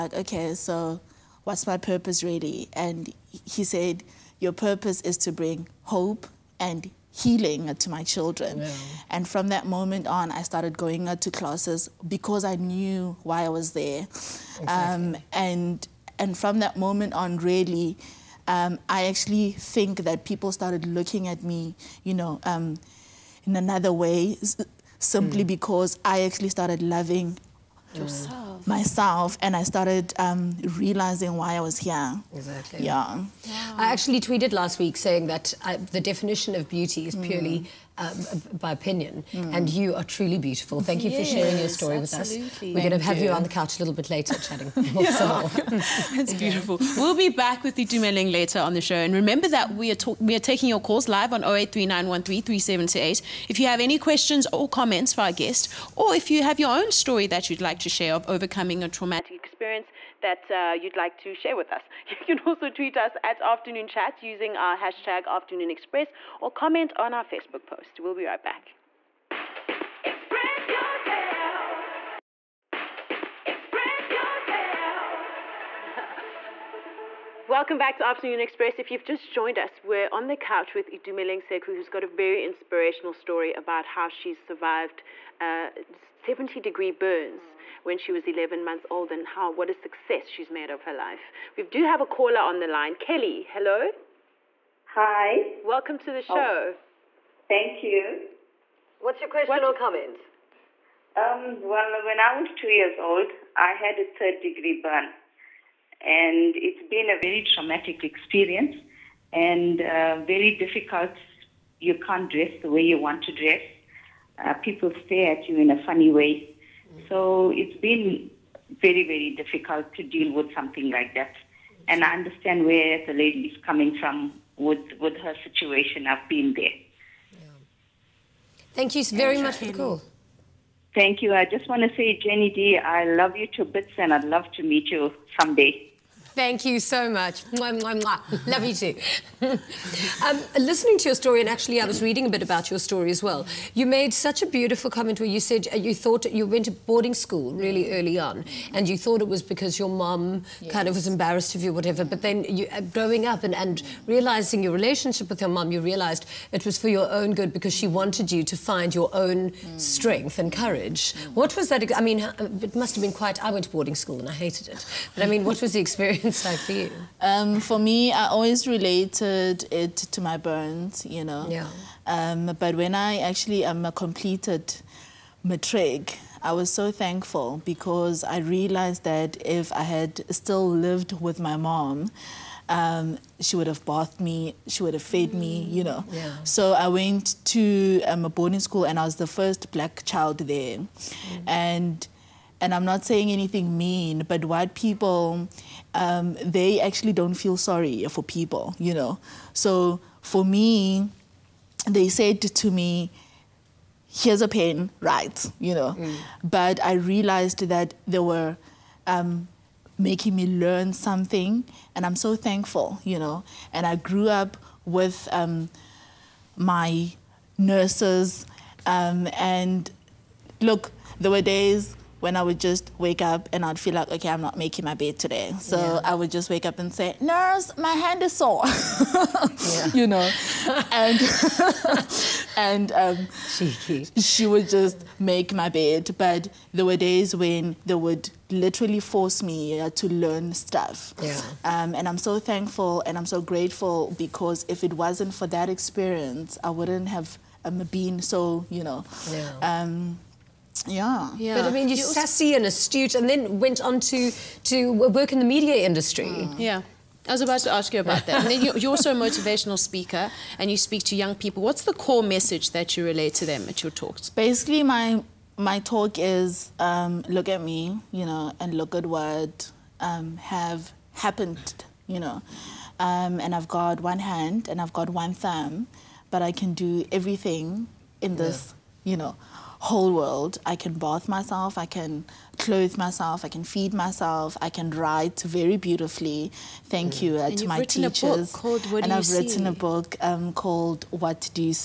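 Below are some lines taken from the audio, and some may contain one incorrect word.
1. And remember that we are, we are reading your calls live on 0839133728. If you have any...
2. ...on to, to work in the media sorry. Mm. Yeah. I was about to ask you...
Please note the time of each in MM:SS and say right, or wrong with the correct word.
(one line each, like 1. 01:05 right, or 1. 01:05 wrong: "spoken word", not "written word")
1. 00:48 wrong: "taking", not "reading"
2. 04:13 wrong: "industry", not "sorry".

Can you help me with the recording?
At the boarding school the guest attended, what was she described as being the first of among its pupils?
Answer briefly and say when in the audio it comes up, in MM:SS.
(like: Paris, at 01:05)
first black child, at 03:09.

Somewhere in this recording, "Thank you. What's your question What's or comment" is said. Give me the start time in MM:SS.
01:37.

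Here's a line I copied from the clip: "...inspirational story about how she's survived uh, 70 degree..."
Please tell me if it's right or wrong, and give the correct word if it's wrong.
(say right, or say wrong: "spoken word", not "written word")
right.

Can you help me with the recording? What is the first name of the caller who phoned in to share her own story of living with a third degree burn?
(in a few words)
Kelly.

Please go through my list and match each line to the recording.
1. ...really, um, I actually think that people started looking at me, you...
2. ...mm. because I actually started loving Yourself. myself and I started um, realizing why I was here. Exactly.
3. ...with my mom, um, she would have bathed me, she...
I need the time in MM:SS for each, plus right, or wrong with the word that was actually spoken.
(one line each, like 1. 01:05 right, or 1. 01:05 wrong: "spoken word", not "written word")
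1. 00:17 right
2. 00:25 right
3. 03:01 right.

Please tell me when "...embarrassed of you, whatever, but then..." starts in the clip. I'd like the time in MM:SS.
02:31.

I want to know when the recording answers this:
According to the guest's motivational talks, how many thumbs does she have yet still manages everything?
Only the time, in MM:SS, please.
04:35.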